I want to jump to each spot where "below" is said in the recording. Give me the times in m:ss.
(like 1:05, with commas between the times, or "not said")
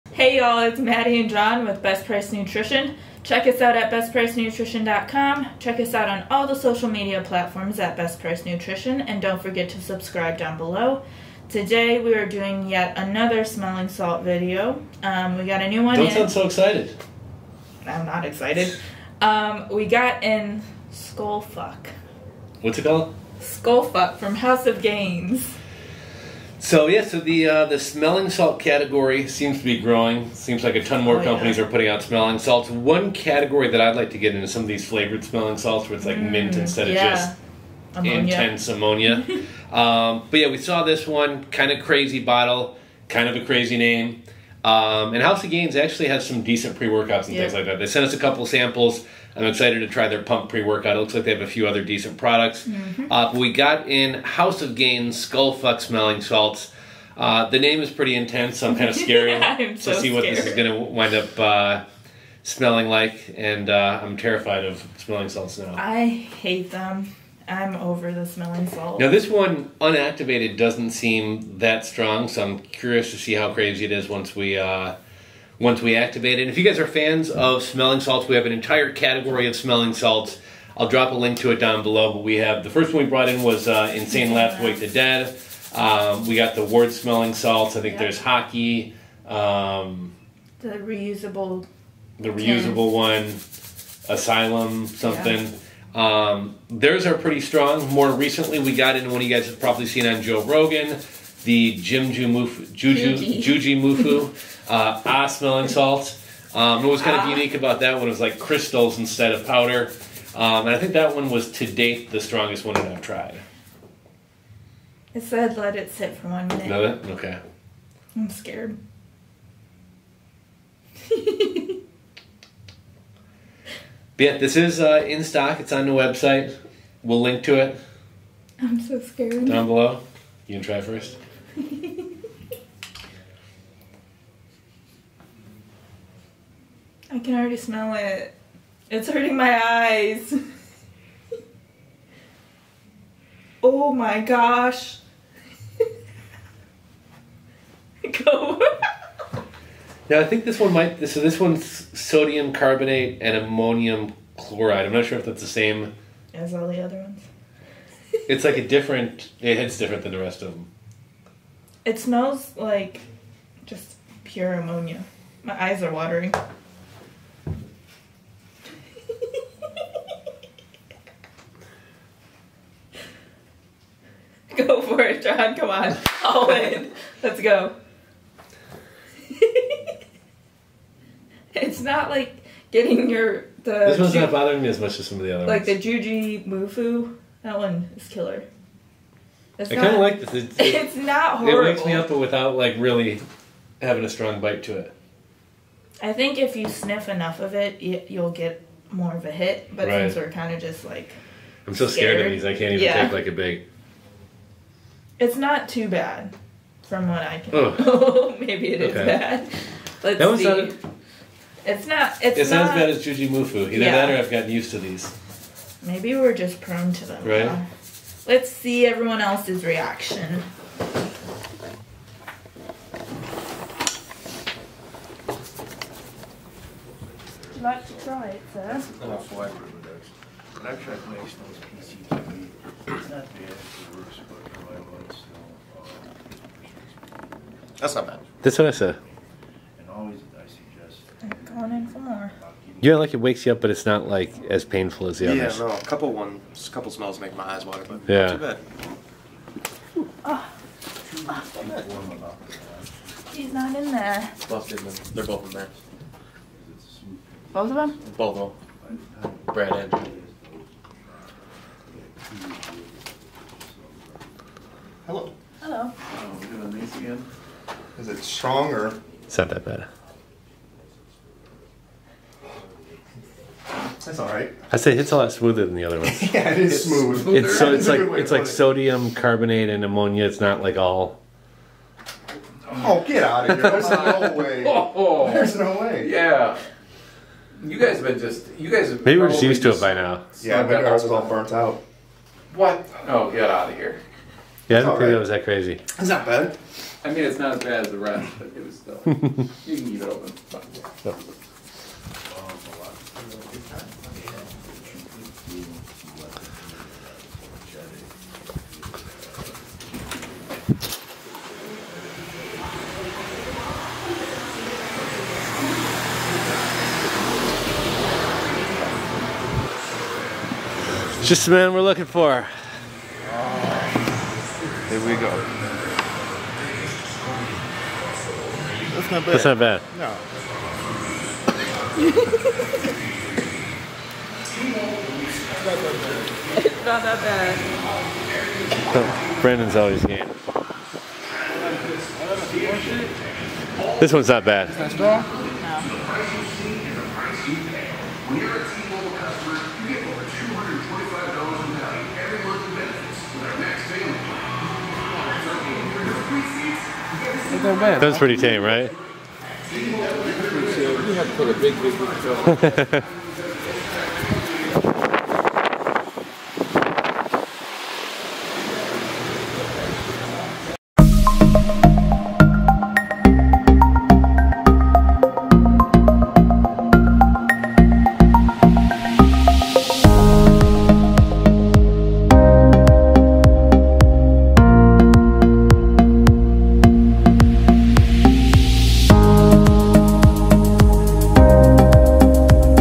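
0:10, 1:21, 2:09.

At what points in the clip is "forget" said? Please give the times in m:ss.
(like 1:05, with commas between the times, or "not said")
0:09.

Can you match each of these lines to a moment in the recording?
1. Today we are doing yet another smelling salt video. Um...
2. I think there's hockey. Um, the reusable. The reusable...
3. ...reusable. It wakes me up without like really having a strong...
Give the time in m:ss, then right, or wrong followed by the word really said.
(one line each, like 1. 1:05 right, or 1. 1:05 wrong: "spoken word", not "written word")
1. 0:11 right
2. 1:27 right
3. 3:11 wrong: "horrible", not "reusable".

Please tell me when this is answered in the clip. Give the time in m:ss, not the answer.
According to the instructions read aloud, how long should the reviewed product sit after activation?
1:56.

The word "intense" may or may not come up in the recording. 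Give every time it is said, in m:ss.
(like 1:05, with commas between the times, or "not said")
0:38, 0:58.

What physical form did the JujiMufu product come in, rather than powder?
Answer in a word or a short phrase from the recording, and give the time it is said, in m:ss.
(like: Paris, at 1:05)
crystals, at 1:48.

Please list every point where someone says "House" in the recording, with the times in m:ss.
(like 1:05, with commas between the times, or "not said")
0:24, 0:45, 0:54.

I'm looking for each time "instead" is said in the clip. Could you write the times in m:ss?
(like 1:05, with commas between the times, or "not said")
0:36, 1:48.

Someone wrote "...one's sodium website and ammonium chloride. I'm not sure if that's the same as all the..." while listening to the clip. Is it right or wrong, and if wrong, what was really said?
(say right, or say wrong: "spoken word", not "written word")
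wrong: "carbonate", not "website".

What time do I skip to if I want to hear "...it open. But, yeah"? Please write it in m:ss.
5:00.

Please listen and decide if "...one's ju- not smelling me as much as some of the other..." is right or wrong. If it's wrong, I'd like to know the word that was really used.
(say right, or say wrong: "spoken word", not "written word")
wrong: "bothering", not "smelling".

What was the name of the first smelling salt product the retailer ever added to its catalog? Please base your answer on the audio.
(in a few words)
Wake the Dead.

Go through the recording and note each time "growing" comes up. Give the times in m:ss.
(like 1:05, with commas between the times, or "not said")
0:29.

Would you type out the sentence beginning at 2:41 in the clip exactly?
It smells like just pure ammonia.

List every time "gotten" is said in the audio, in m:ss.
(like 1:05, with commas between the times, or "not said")
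3:34.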